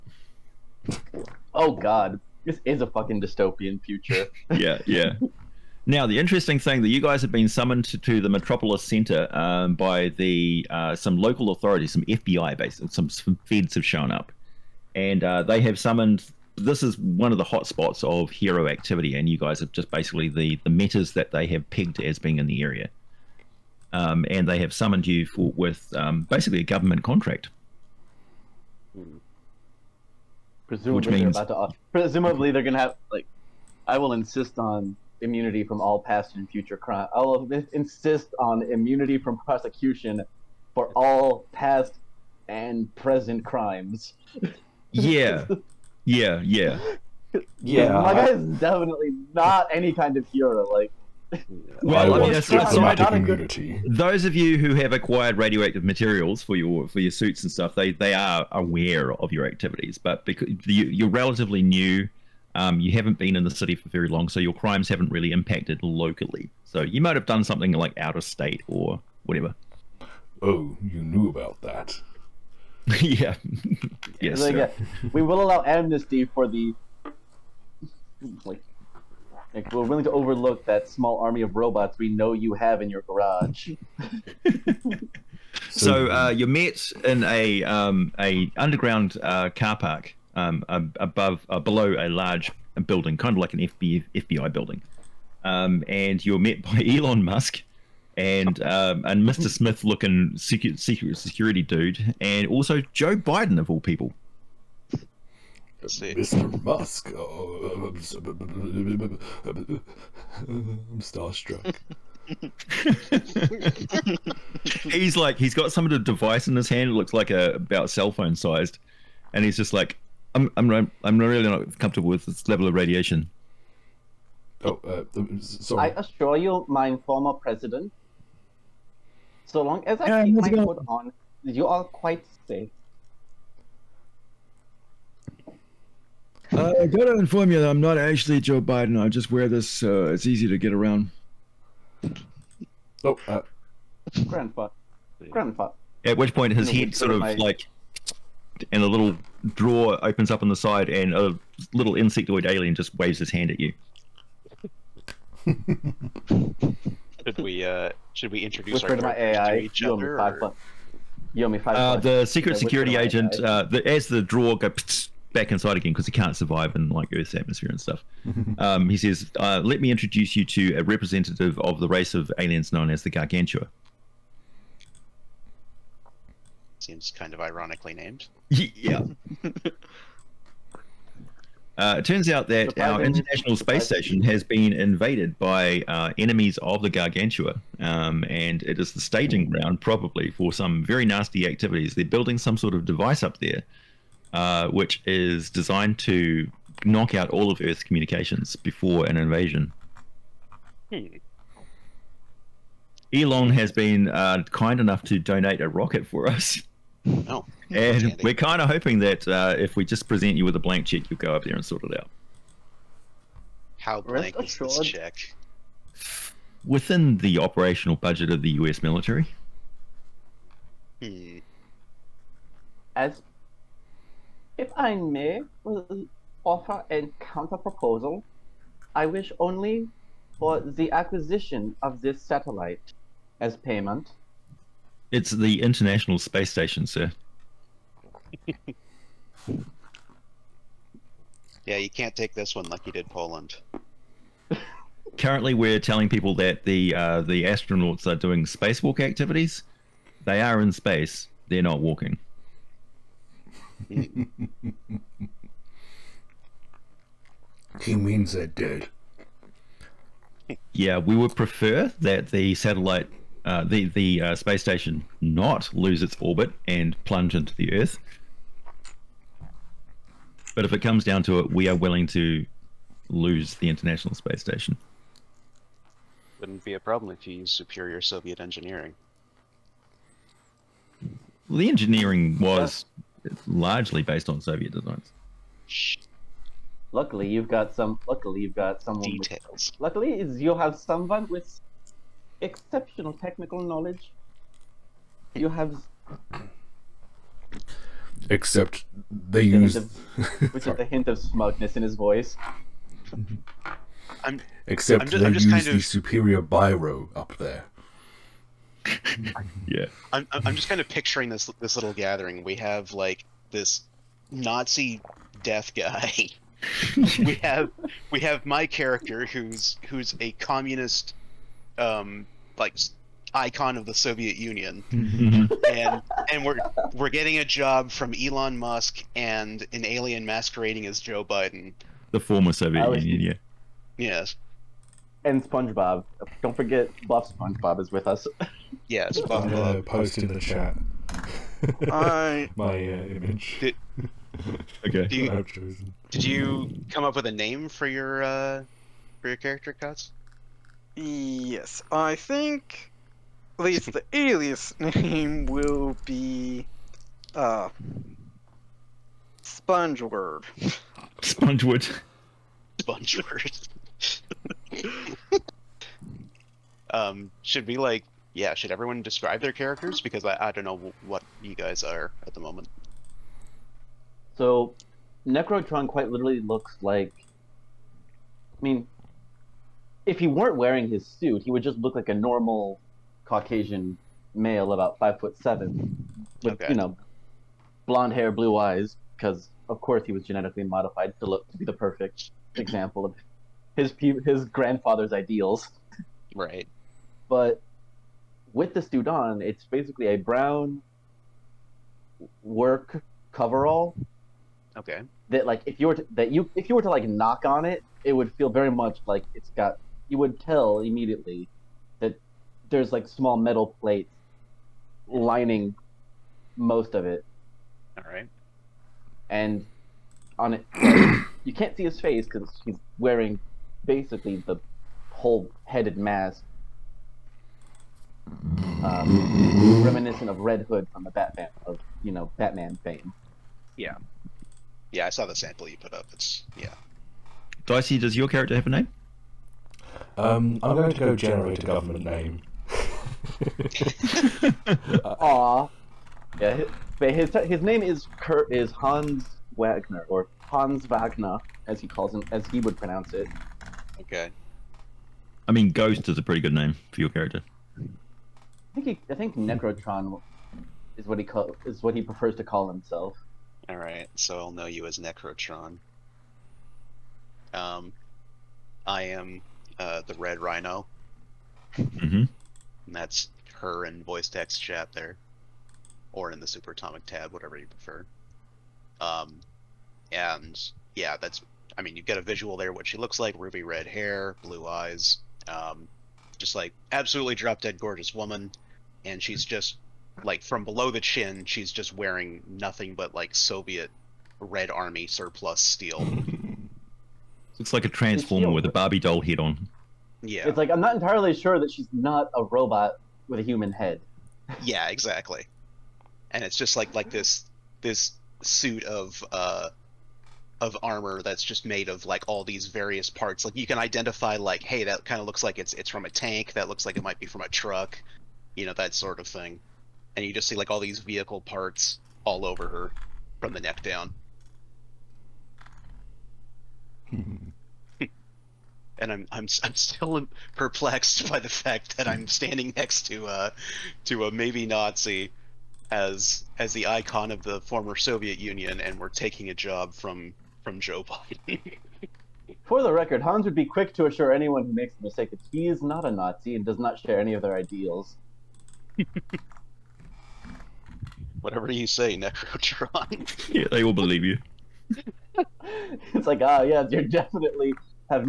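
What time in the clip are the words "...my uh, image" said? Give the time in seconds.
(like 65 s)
342 s.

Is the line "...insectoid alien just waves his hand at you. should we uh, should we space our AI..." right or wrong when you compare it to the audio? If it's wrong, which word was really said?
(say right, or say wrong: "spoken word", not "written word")
wrong: "introduce", not "space".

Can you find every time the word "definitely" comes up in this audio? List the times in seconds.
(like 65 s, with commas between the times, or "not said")
48 s, 557 s.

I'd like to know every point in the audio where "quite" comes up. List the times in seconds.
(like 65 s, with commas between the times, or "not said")
131 s, 375 s.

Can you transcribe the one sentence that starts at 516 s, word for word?
That looks like it might be from a truck, you know, that sort of thing.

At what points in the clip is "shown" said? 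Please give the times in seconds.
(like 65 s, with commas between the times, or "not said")
13 s.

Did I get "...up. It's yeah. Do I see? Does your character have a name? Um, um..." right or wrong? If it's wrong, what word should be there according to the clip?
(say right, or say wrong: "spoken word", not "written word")
right.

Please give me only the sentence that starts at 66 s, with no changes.
So you might have done something like out of state or whatever.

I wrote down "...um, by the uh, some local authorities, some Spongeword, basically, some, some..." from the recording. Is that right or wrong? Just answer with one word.
wrong.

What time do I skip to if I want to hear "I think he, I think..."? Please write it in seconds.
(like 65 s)
457 s.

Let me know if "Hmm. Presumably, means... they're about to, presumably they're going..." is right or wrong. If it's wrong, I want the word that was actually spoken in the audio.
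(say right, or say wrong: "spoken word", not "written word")
right.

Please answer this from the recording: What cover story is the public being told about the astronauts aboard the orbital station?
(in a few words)
Spacewalk activities.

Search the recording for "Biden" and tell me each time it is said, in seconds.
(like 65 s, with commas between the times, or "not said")
103 s, 138 s, 331 s, 541 s.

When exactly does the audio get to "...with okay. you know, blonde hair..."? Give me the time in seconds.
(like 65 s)
386 s.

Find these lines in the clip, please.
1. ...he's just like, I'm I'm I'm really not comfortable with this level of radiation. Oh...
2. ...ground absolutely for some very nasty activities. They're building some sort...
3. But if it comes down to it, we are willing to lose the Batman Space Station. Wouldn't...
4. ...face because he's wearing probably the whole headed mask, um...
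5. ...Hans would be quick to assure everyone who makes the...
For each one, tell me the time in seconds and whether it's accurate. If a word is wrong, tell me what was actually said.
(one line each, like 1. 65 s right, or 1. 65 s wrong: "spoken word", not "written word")
1. 119 s right
2. 189 s wrong: "probably", not "absolutely"
3. 270 s wrong: "International", not "Batman"
4. 421 s wrong: "basically", not "probably"
5. 543 s wrong: "anyone", not "everyone".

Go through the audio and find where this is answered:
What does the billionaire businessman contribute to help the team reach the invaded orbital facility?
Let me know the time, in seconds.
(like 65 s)
205 s.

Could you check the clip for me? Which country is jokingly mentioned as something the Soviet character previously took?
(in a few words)
Poland.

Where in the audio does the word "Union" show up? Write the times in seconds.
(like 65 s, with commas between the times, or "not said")
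324 s, 333 s, 538 s.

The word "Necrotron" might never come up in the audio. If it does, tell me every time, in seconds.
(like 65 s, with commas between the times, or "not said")
375 s, 459 s, 464 s, 552 s.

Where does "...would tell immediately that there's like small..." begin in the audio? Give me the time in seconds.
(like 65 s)
410 s.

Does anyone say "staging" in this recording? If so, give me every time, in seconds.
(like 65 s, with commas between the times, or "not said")
189 s.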